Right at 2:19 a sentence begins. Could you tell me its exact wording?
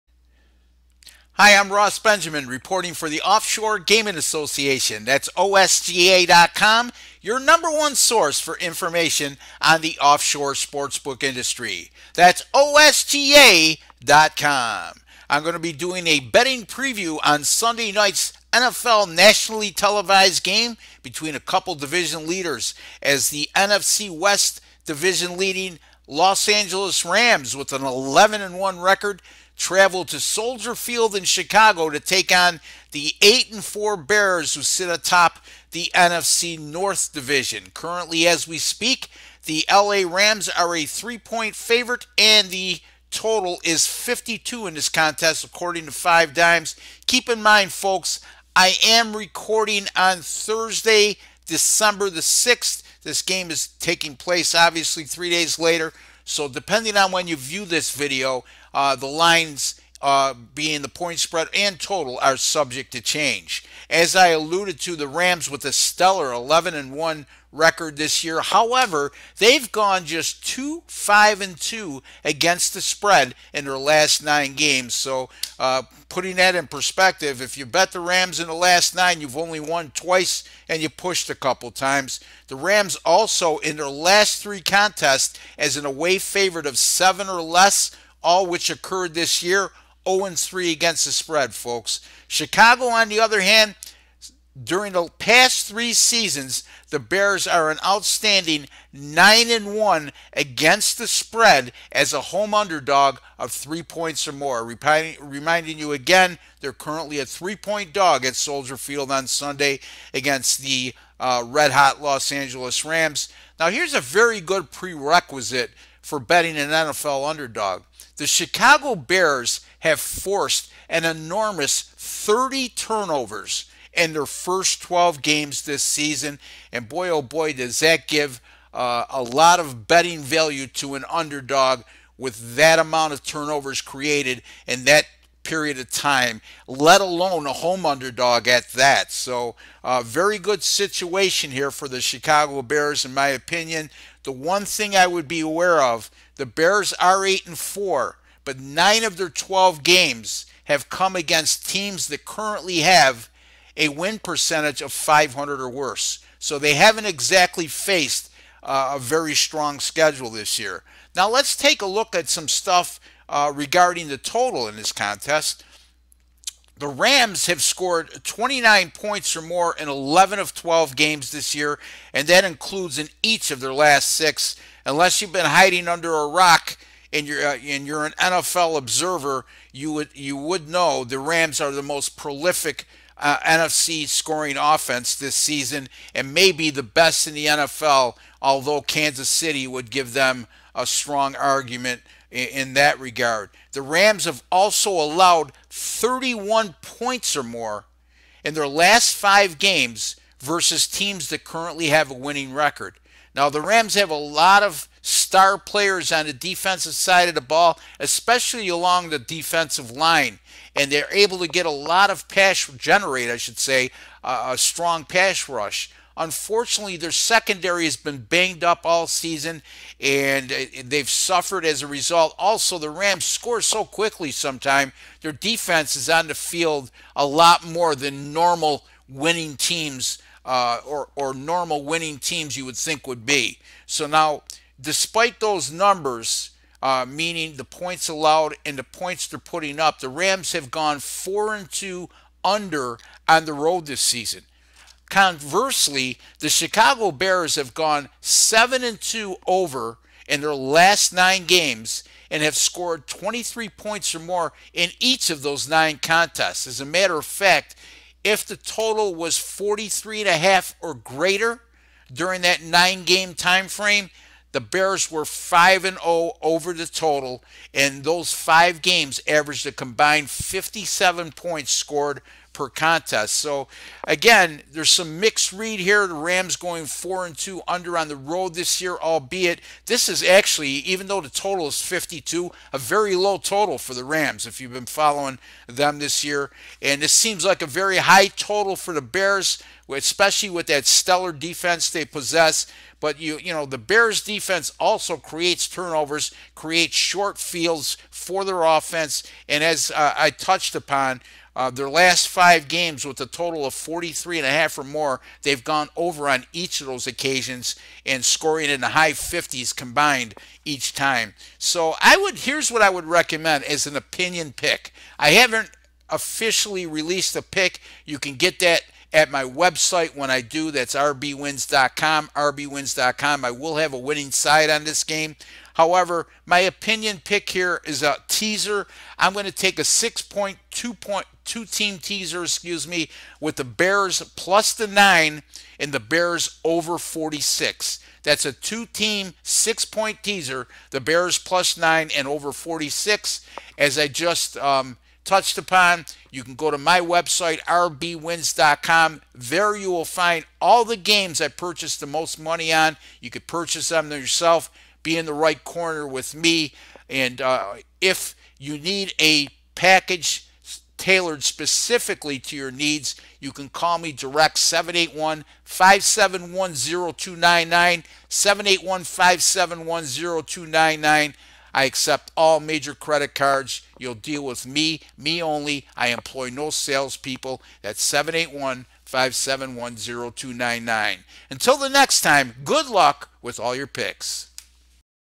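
So, uh, very good situation here for the Chicago Bears, in my opinion.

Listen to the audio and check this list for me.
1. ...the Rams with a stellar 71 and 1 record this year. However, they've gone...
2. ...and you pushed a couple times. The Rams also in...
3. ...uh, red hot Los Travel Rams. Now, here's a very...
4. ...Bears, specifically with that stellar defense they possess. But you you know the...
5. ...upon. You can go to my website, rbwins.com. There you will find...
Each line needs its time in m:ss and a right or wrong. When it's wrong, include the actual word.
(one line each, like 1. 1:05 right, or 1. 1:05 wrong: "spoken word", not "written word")
1. 1:04 wrong: "11", not "71"
2. 1:20 right
3. 1:51 wrong: "Angeles", not "Travel"
4. 4:49 wrong: "especially", not "specifically"
5. 5:45 right.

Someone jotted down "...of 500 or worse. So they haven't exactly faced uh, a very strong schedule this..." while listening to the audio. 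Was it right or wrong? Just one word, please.
right.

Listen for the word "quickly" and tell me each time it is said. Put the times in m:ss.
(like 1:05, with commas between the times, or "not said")
3:43.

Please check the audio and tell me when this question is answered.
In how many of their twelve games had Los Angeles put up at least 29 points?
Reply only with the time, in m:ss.
2:49.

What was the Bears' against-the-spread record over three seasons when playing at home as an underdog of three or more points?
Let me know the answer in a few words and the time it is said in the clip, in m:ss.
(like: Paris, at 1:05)
9 and 1, at 1:38.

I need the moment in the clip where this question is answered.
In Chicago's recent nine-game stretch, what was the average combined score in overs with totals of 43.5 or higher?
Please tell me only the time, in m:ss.
4:30.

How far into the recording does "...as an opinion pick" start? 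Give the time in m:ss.
5:13.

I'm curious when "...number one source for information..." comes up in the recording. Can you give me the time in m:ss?
0:07.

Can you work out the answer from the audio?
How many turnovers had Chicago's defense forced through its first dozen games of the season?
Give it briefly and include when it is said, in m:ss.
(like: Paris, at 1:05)
30, at 2:01.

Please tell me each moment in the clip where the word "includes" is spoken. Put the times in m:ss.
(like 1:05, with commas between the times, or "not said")
2:52.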